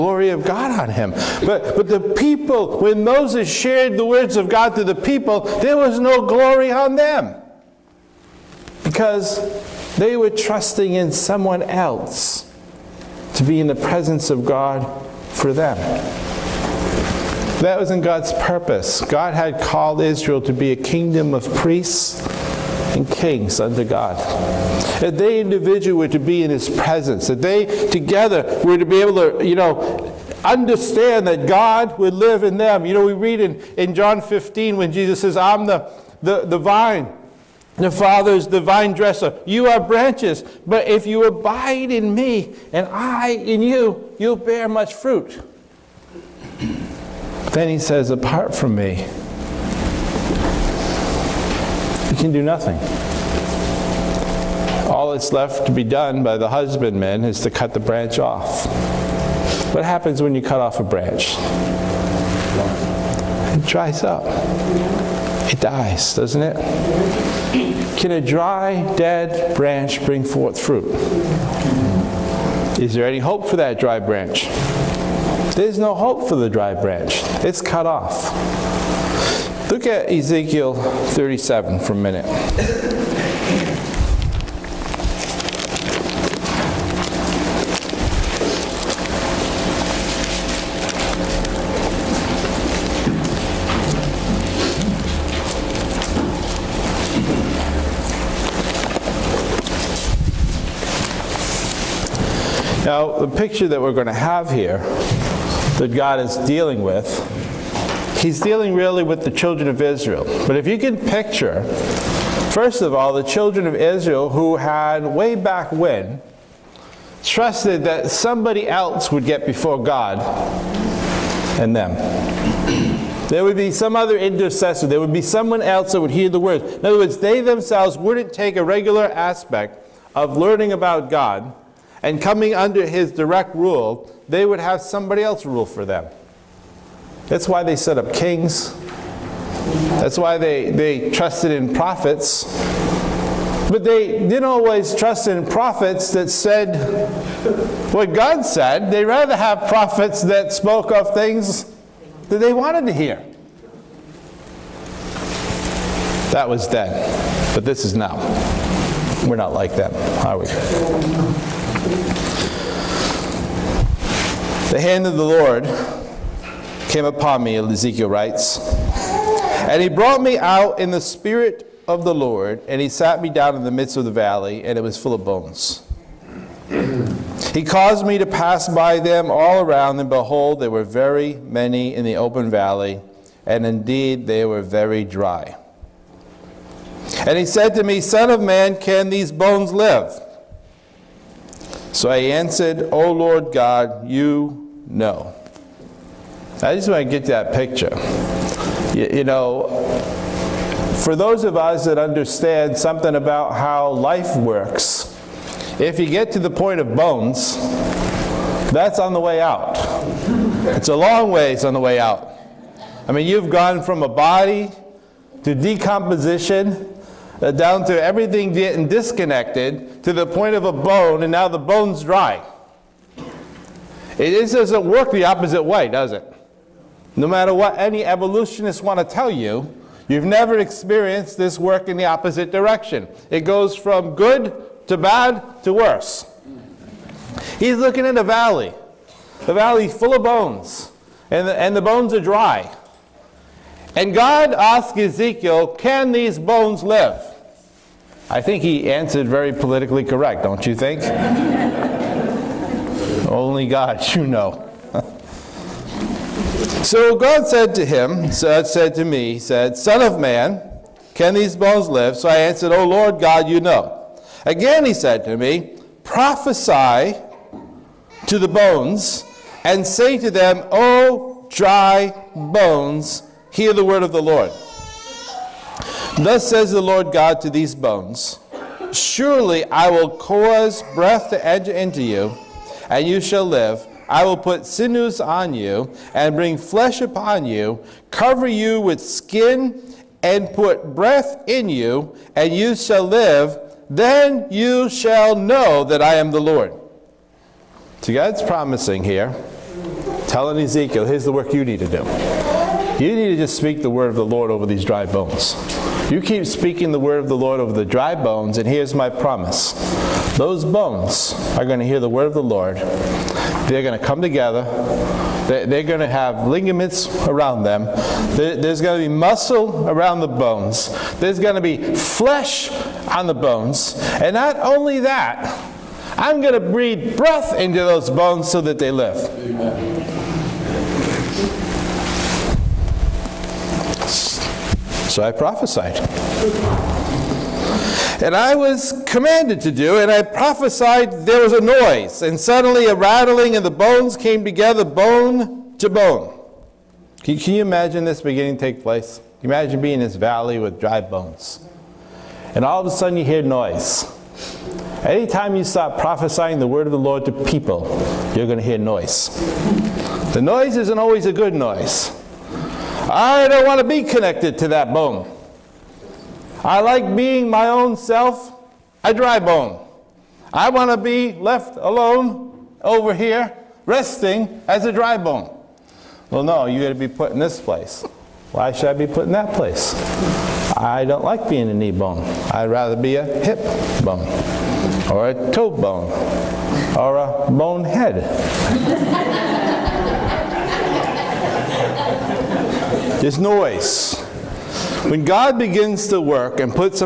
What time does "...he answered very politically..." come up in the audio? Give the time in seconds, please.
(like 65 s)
248 s.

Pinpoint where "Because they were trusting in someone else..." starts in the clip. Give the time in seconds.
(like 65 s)
8 s.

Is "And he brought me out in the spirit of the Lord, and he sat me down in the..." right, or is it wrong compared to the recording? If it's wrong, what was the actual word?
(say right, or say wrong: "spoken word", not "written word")
right.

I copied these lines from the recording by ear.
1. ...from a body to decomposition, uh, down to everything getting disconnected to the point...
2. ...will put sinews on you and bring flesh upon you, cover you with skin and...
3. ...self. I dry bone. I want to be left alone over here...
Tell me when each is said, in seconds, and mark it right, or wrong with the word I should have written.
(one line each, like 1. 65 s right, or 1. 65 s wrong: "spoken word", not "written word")
1. 213 s right
2. 284 s right
3. 367 s right.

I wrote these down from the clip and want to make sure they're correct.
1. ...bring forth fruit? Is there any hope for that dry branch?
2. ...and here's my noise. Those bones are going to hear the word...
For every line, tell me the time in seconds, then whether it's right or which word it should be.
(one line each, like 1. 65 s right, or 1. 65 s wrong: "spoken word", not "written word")
1. 70 s right
2. 308 s wrong: "promise", not "noise".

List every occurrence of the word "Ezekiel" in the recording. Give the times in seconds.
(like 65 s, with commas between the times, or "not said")
80 s, 167 s, 244 s, 300 s.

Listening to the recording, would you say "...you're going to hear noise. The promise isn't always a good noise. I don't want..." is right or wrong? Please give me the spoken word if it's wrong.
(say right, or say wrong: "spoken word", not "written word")
wrong: "noise", not "promise".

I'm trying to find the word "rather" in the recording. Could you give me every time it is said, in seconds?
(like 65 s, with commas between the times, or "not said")
149 s, 382 s.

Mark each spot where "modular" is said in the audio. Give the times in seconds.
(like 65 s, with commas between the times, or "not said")
not said.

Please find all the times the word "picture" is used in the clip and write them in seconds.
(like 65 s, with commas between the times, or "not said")
103 s, 110 s, 197 s.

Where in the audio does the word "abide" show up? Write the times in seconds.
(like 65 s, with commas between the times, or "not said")
41 s.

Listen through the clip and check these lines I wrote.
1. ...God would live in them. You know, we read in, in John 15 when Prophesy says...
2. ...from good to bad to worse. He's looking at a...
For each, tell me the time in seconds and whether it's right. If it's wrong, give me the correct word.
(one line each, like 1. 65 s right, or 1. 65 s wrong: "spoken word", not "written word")
1. 31 s wrong: "Jesus", not "Prophesy"
2. 233 s right.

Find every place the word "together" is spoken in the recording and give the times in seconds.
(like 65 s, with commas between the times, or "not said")
27 s, 314 s, 344 s.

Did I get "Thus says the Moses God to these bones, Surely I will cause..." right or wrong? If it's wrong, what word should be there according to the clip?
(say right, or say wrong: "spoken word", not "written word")
wrong: "Lord", not "Moses".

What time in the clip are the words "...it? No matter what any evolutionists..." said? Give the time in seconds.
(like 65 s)
226 s.